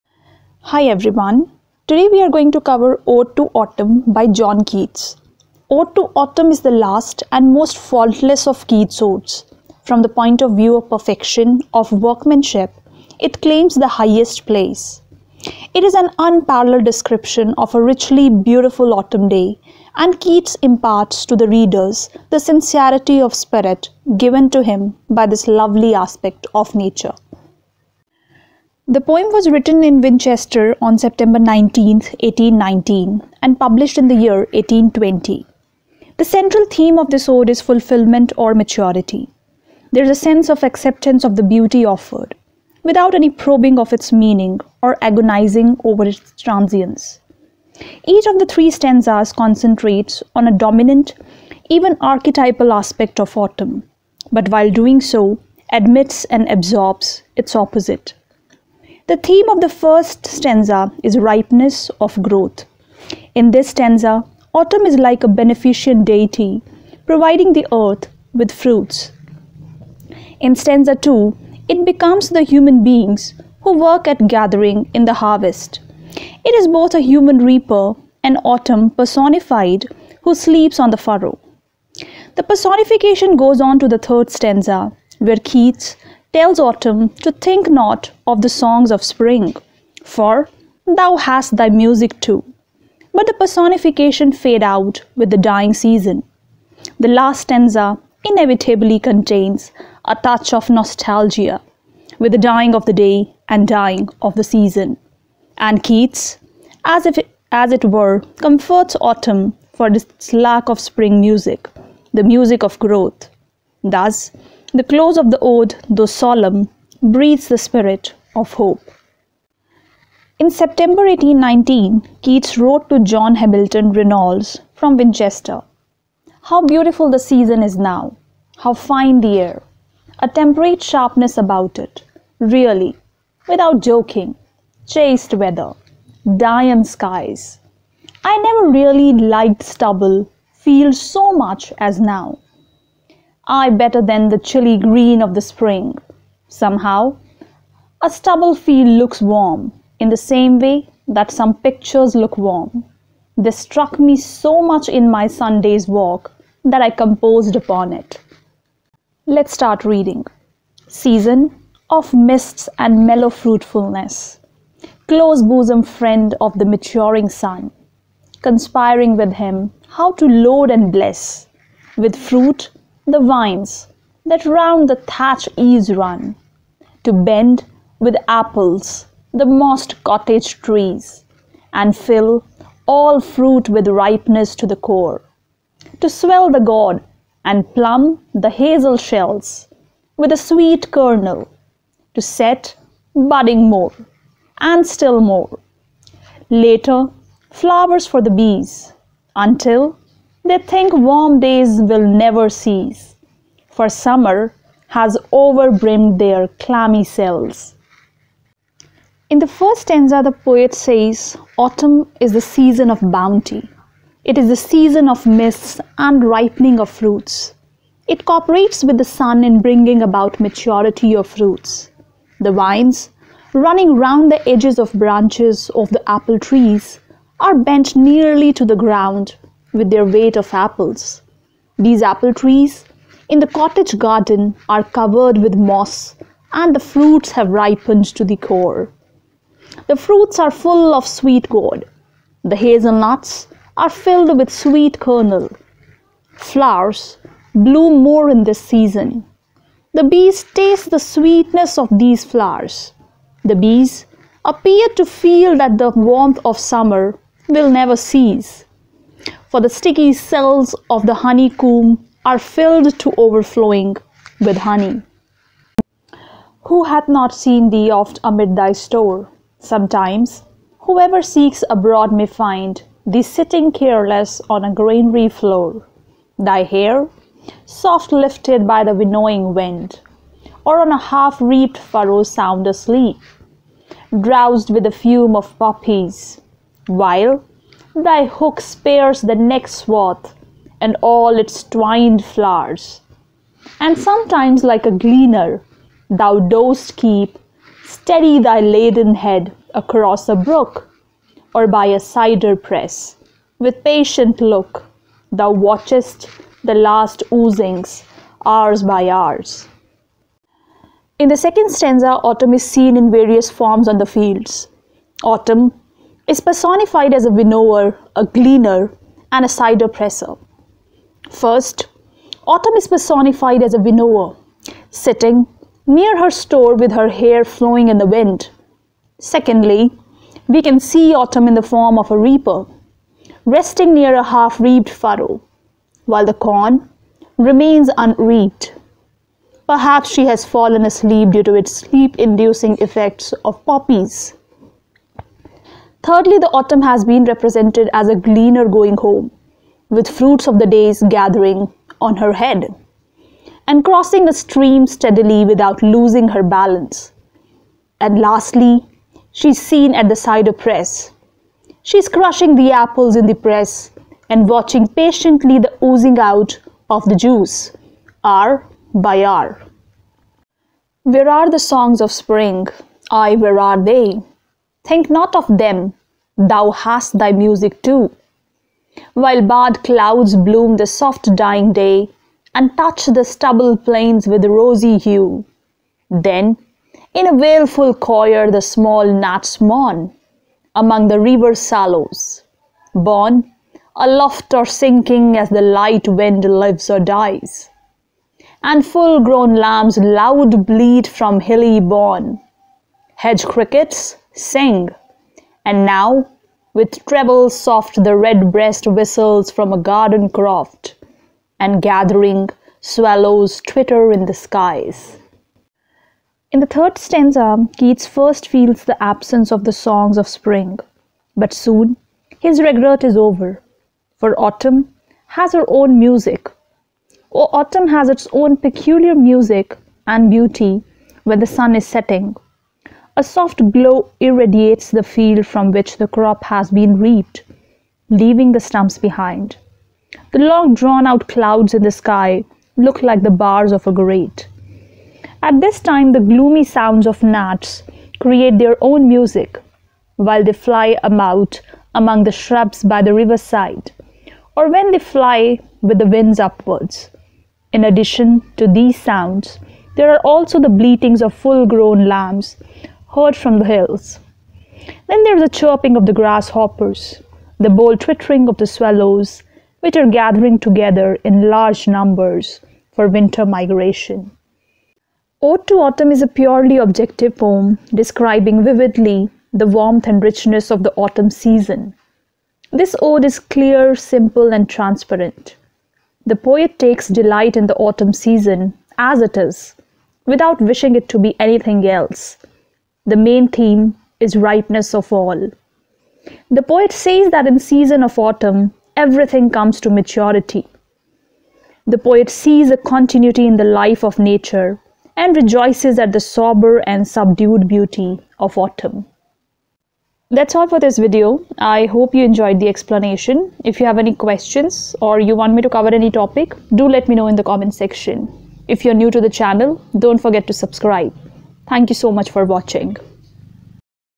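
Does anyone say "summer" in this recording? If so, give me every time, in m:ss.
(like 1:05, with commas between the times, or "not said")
3:23, 4:16.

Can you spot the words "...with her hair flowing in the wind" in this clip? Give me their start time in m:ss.
5:26.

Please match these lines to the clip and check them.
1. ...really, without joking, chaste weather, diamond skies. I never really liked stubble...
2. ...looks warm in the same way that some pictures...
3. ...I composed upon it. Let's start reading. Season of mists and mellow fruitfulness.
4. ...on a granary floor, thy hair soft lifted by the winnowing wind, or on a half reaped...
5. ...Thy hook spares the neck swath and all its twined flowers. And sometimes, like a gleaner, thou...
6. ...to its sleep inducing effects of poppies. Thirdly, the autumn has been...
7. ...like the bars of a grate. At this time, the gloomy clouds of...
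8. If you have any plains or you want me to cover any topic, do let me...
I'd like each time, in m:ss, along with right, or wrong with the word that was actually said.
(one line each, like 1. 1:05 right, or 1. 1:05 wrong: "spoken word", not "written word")
1. 2:12 right
2. 2:28 right
3. 2:36 right
4. 4:34 right
5. 4:47 right
6. 5:41 right
7. 7:23 wrong: "sounds", not "clouds"
8. 8:33 wrong: "questions", not "plains".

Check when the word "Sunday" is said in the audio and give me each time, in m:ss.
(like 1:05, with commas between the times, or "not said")
2:35.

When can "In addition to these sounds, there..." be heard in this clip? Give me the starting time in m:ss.
7:37.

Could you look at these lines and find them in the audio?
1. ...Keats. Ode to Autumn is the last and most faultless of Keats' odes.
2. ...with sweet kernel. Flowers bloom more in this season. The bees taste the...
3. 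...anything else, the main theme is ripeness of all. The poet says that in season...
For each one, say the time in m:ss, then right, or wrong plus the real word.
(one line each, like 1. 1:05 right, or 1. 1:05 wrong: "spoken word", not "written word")
1. 0:04 right
2. 4:04 right
3. 8:11 right.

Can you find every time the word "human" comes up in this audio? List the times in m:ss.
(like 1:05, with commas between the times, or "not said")
1:12, 1:16.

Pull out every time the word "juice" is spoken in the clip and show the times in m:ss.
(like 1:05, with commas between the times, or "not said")
6:07.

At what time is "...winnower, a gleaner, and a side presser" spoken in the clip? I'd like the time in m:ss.
5:17.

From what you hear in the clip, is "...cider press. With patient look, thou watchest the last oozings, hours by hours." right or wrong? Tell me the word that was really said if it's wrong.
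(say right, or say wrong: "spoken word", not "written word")
right.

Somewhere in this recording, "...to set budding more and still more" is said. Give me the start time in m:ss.
3:12.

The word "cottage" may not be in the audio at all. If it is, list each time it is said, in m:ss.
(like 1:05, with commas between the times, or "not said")
3:00, 3:53.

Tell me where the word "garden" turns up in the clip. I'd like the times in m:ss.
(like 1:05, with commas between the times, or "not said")
3:53, 6:49.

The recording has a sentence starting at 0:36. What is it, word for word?
The central theme of this ode is fulfillment or maturity.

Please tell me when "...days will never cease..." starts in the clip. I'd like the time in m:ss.
3:21.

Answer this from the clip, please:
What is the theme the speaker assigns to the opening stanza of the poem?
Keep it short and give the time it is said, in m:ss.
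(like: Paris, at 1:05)
ripeness of growth, at 1:01.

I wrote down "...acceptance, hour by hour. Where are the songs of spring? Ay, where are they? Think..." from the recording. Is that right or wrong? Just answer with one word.
wrong.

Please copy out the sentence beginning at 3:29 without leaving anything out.
In the first stanza, the poet says, Autumn is the season of bounty.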